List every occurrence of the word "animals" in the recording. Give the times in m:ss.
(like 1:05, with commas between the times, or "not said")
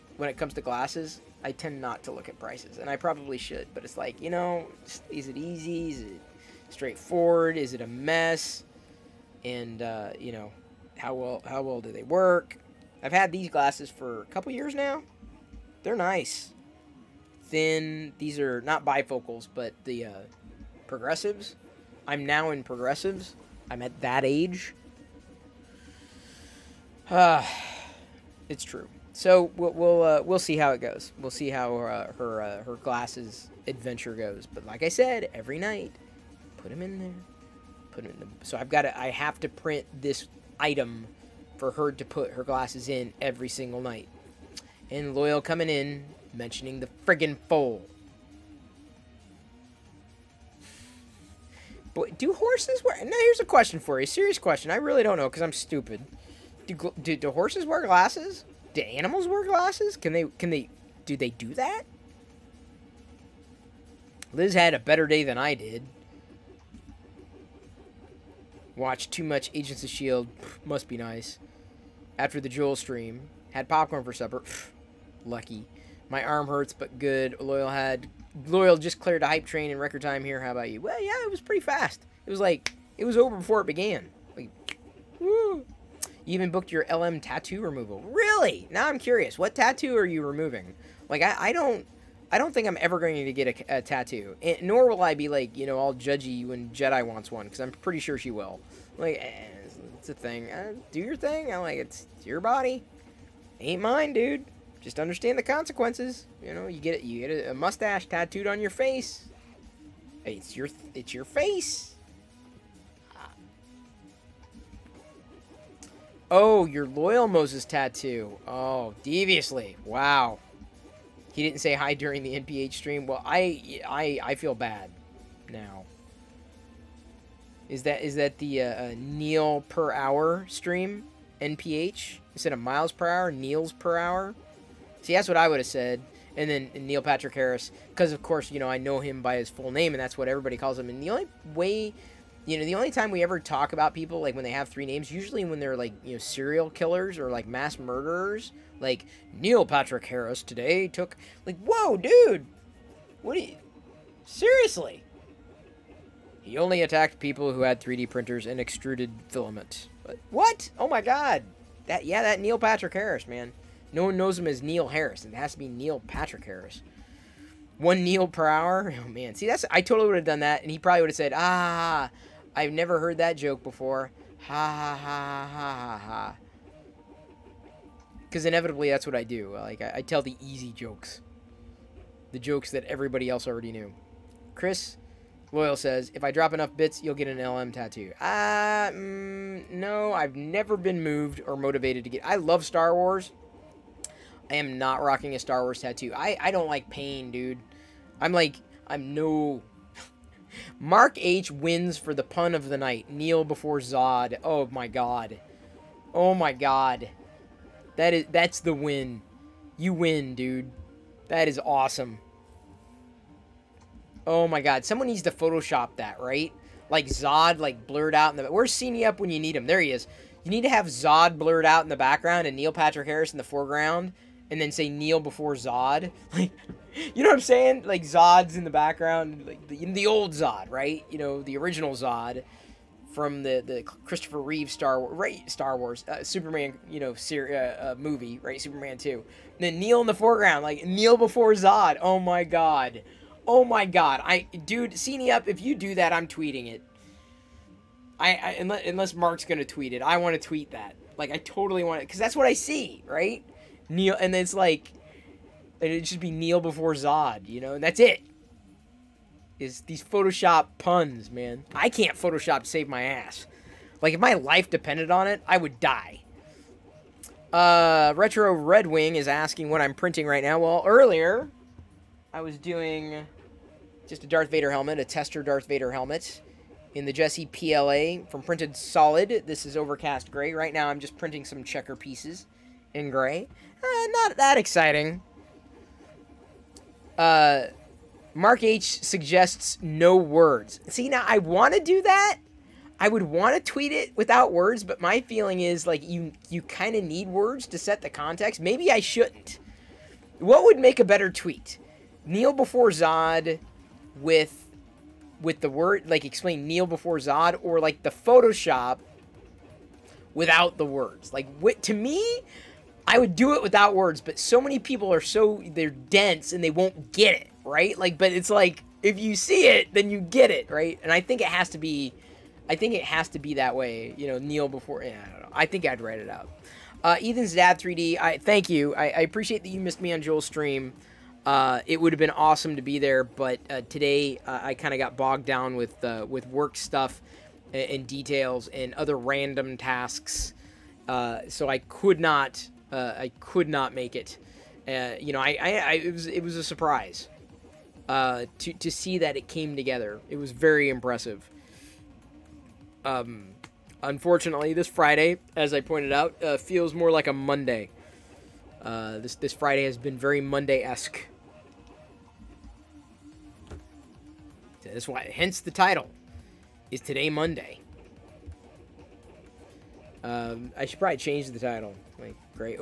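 0:58.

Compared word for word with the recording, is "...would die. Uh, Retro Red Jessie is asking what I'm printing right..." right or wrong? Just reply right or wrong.
wrong.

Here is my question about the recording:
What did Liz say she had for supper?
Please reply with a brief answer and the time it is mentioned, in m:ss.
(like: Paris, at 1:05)
Popcorn, at 1:13.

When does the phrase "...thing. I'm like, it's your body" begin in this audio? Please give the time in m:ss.
1:41.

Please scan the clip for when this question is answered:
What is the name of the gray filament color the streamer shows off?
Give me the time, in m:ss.
4:39.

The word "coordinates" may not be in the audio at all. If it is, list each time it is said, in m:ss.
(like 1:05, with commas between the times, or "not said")
not said.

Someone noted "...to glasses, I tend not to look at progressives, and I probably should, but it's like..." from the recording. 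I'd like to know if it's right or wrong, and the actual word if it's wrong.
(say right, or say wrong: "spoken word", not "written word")
wrong: "prices", not "progressives".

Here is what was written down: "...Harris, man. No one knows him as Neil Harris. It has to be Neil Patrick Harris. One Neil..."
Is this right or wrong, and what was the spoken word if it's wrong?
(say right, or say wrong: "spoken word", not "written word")
right.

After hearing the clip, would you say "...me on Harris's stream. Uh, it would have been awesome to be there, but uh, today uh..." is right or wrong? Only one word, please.
wrong.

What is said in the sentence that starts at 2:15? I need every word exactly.
See, that's what I would have said.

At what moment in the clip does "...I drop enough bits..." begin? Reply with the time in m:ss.
3:06.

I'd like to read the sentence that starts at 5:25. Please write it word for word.
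I think I'd write it up.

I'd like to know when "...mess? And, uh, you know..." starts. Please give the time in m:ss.
0:07.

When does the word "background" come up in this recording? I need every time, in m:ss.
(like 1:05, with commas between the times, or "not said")
3:41, 3:48.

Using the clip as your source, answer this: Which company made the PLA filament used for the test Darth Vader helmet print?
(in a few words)
Printed Solid.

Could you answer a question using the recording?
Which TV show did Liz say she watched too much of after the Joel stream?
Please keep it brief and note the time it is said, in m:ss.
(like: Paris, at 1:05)
Agents of S.H.I.E.L.D., at 1:09.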